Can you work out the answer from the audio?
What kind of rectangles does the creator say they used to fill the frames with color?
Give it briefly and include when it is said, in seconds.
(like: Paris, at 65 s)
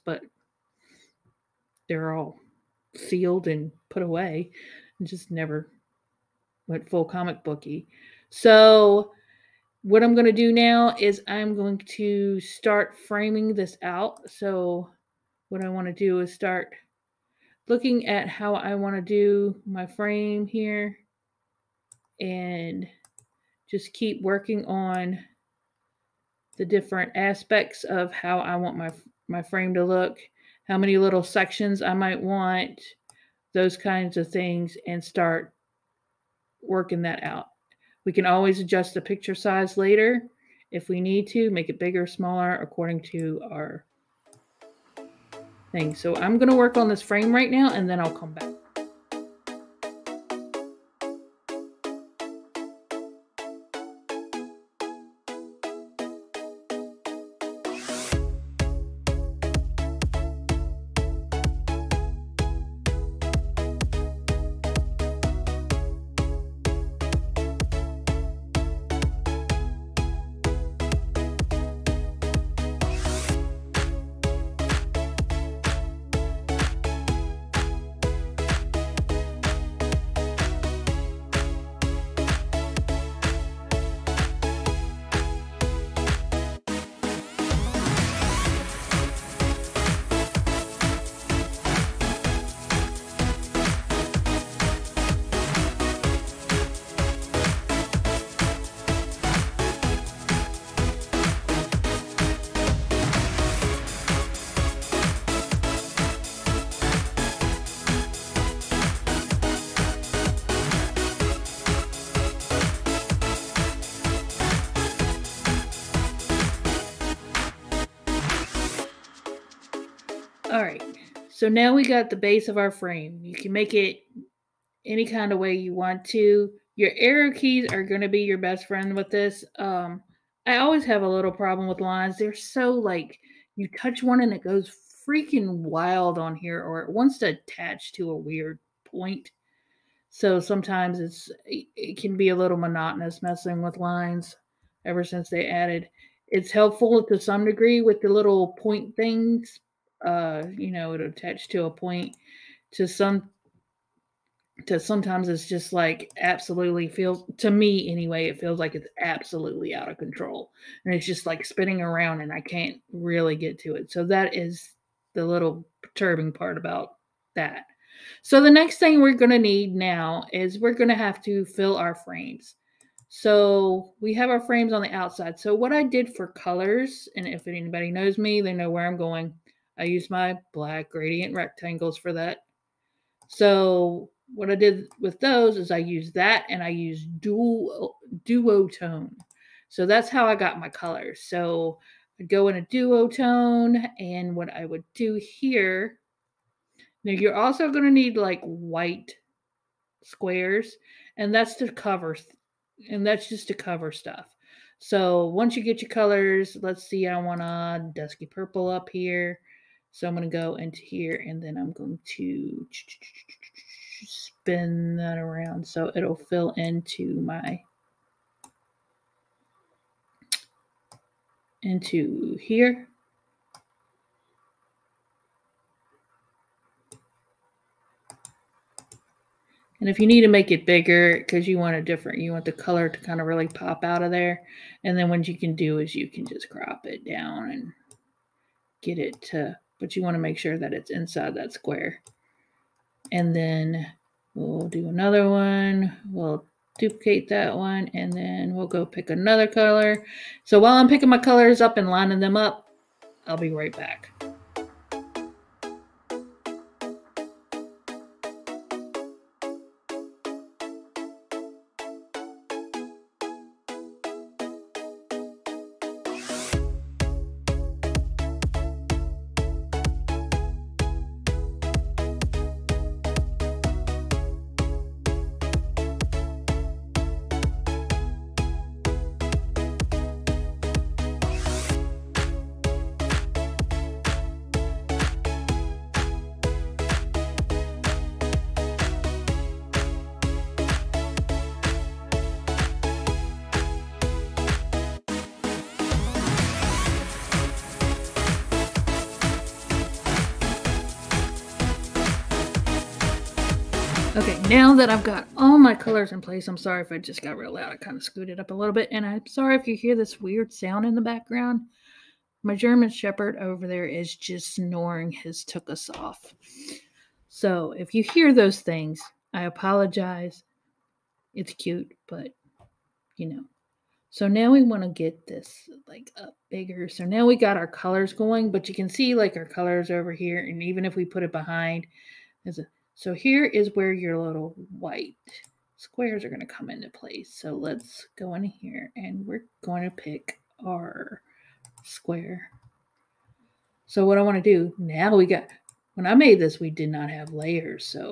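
Black gradient rectangles, at 180 s.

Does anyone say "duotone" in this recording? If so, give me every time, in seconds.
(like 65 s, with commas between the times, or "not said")
188 s, 192 s.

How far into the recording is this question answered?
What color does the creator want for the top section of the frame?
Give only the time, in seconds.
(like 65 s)
207 s.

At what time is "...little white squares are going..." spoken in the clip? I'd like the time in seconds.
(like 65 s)
334 s.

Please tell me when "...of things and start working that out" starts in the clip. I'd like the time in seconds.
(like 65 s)
34 s.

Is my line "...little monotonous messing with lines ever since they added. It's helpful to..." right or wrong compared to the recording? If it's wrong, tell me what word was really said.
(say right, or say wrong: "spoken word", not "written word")
right.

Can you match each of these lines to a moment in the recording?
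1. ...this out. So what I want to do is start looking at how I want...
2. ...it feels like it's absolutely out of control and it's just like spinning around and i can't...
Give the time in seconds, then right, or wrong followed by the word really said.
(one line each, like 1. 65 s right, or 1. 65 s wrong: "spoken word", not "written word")
1. 13 s right
2. 158 s right.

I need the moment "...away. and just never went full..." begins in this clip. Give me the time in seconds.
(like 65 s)
4 s.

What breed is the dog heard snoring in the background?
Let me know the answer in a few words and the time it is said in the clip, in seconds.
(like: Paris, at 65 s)
German Shepherd, at 312 s.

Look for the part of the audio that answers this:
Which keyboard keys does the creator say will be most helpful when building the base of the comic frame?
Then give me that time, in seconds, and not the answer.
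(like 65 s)
126 s.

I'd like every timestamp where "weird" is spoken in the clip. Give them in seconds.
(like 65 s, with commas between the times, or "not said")
138 s, 310 s.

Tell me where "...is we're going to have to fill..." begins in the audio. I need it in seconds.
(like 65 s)
170 s.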